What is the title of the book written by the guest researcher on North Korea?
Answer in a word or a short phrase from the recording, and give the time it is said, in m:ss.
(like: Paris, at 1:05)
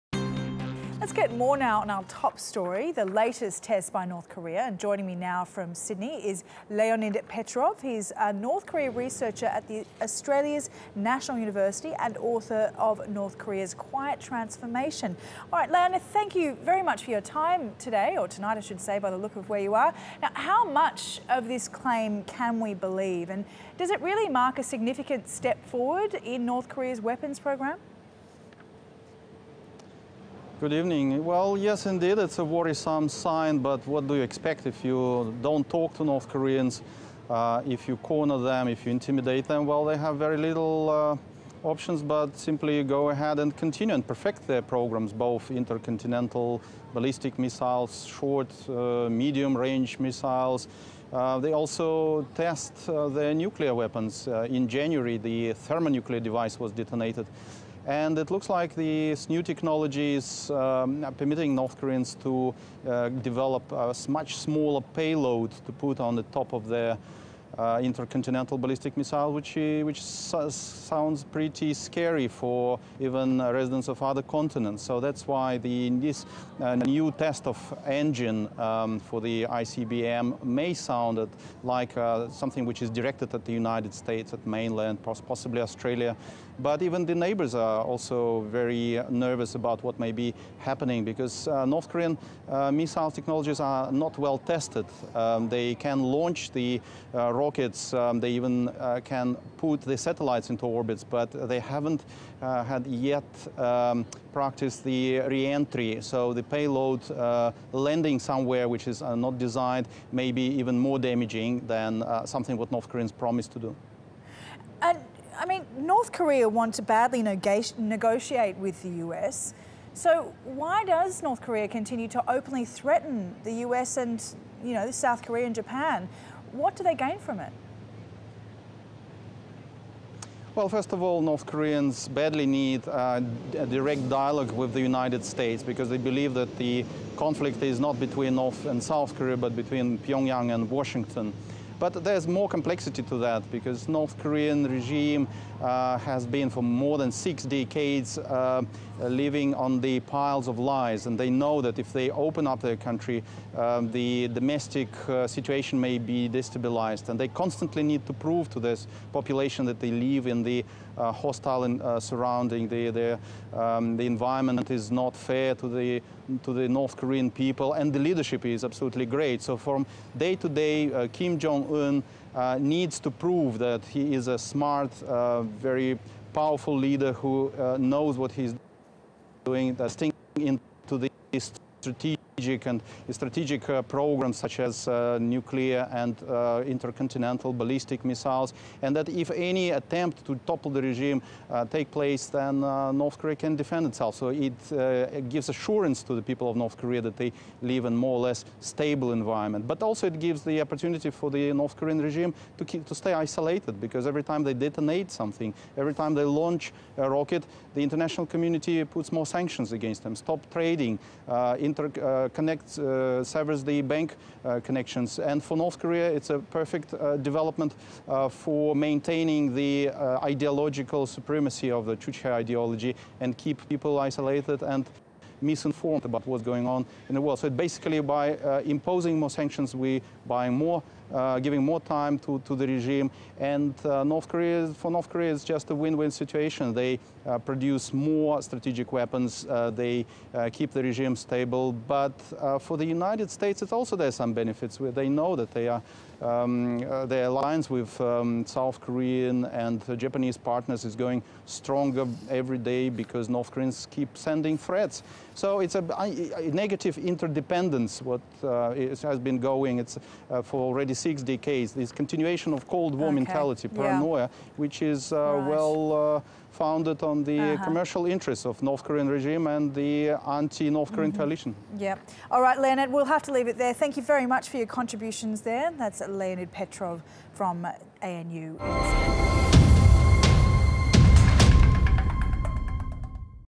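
North Korea's Quiet Transformation, at 0:13.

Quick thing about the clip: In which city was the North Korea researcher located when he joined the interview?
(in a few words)
Sydney.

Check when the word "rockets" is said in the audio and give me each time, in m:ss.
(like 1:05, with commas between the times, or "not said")
1:37, 3:27.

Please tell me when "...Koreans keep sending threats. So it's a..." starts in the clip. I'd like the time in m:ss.
4:13.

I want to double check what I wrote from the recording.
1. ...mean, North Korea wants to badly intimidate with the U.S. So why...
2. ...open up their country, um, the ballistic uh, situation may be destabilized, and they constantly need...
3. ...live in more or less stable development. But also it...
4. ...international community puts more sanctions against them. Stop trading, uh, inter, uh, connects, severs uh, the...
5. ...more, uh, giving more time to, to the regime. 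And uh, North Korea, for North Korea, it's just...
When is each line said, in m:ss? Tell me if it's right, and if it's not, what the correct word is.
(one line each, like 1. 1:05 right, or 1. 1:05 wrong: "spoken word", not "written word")
1. 1:55 wrong: "negotiate", not "intimidate"
2. 2:32 wrong: "domestic", not "ballistic"
3. 3:17 wrong: "environment", not "development"
4. 3:27 right
5. 3:50 right.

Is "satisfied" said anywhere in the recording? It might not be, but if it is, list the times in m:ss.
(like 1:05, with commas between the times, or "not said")
not said.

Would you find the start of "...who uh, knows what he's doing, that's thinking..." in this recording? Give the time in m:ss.
2:57.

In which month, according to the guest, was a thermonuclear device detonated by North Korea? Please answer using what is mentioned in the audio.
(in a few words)
January.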